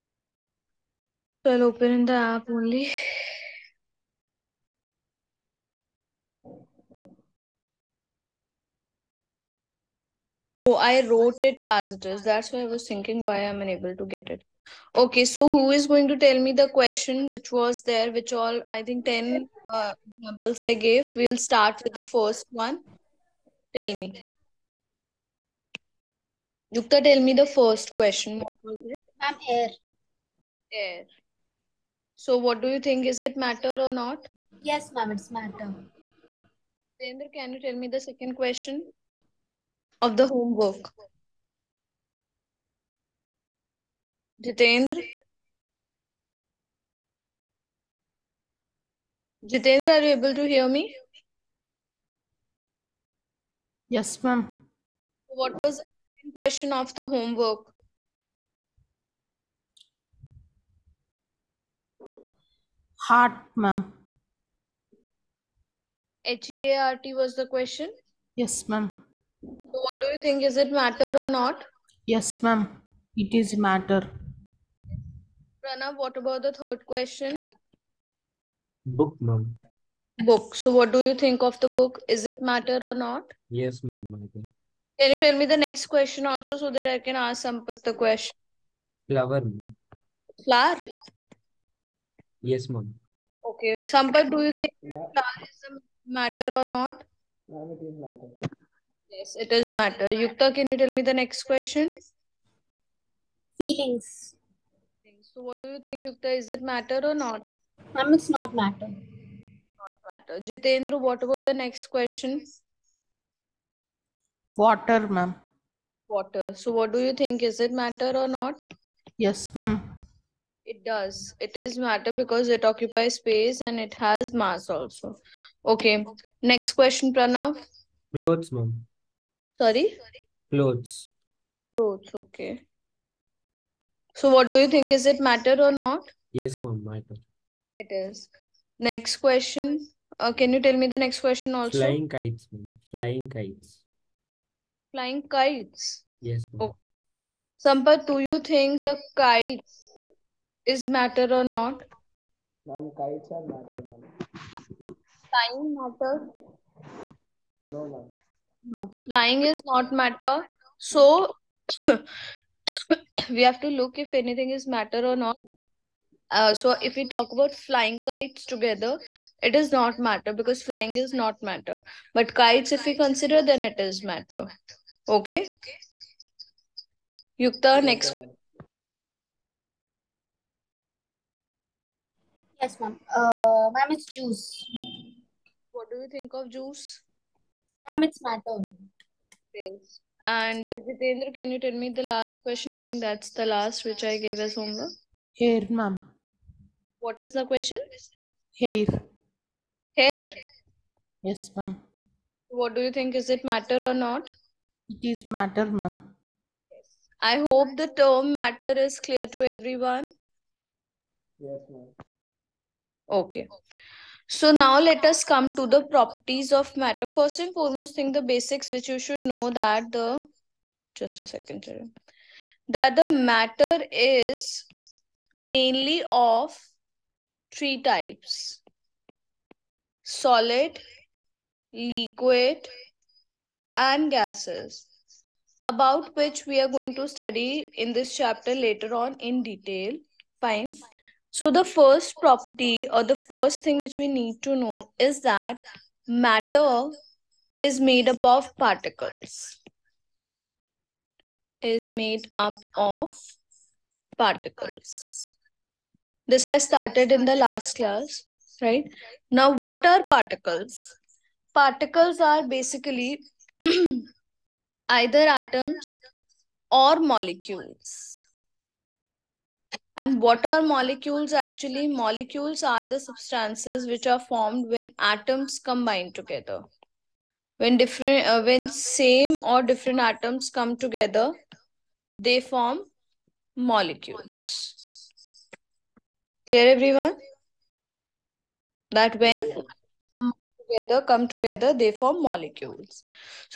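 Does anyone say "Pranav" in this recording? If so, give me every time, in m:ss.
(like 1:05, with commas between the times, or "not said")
1:15, 2:07.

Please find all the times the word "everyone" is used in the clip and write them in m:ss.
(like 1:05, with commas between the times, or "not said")
3:29, 4:46.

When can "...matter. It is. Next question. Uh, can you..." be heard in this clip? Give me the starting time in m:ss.
2:16.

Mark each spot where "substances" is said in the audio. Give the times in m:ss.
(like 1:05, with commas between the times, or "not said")
4:32.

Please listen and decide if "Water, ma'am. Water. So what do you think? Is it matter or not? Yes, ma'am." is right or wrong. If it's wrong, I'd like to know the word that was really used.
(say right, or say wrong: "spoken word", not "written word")
right.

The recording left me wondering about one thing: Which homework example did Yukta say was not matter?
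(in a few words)
Feelings.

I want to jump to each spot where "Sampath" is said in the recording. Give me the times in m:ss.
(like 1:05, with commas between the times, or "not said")
1:27, 1:33, 2:27.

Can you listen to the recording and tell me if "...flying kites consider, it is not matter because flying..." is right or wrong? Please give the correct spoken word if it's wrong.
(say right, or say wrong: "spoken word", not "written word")
wrong: "together", not "consider".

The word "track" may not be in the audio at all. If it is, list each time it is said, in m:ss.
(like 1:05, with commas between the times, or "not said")
not said.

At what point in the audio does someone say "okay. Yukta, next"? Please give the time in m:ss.
2:55.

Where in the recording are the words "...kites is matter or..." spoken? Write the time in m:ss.
2:29.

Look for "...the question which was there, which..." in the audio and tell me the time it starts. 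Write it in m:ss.
0:16.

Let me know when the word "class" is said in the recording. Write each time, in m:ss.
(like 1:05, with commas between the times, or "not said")
4:17.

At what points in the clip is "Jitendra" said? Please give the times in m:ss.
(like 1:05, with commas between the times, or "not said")
0:44, 0:49, 1:50, 3:10.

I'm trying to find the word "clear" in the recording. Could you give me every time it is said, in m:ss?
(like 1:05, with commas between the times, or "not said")
3:28, 4:46.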